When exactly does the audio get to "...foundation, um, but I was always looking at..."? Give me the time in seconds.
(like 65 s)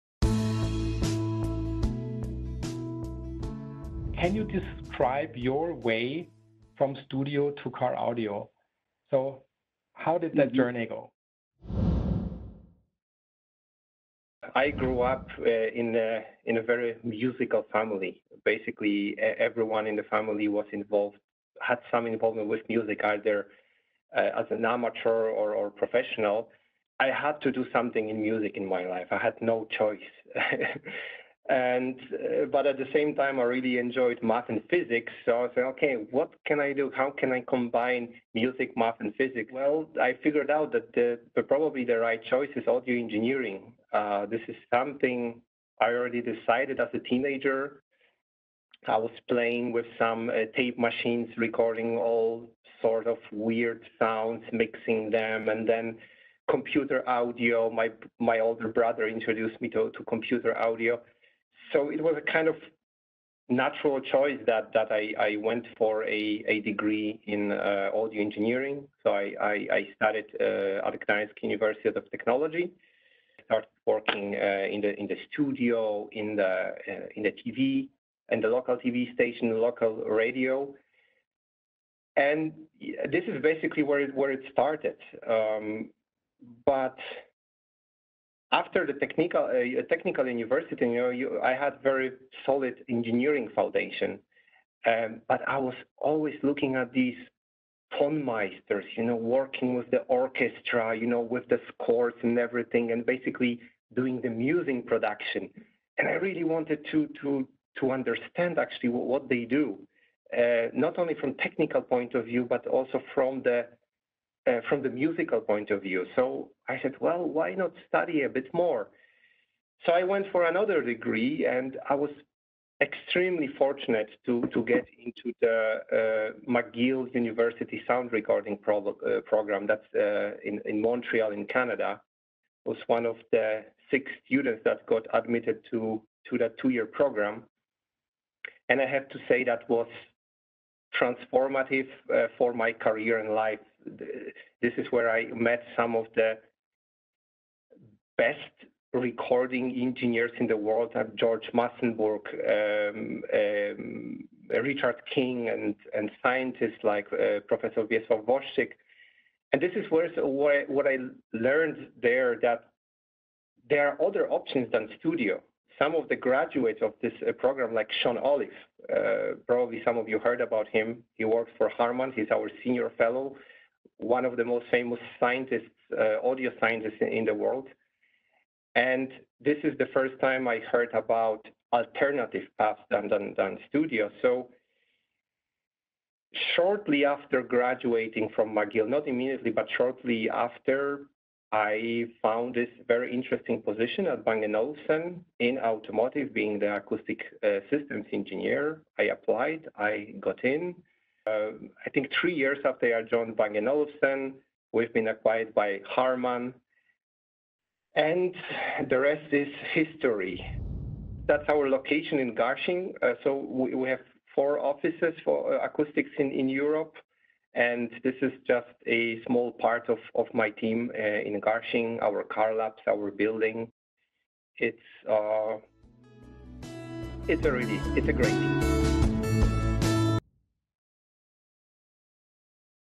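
93 s.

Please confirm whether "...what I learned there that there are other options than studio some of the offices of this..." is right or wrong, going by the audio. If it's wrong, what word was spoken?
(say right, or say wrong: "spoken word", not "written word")
wrong: "graduates", not "offices".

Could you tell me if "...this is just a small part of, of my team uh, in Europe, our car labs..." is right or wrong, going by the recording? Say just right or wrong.
wrong.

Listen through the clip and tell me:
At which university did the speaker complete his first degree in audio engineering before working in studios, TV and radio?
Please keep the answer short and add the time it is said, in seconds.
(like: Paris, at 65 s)
Gdańsk University of Technology, at 71 s.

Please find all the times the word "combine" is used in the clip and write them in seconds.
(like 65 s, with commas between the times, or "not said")
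37 s.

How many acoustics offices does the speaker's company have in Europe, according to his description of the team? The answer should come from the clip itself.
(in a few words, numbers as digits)
4.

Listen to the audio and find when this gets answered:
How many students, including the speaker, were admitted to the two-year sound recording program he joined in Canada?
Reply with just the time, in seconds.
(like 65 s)
133 s.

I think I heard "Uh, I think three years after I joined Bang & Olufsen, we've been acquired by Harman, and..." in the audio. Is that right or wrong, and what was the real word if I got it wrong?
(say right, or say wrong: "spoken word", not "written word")
right.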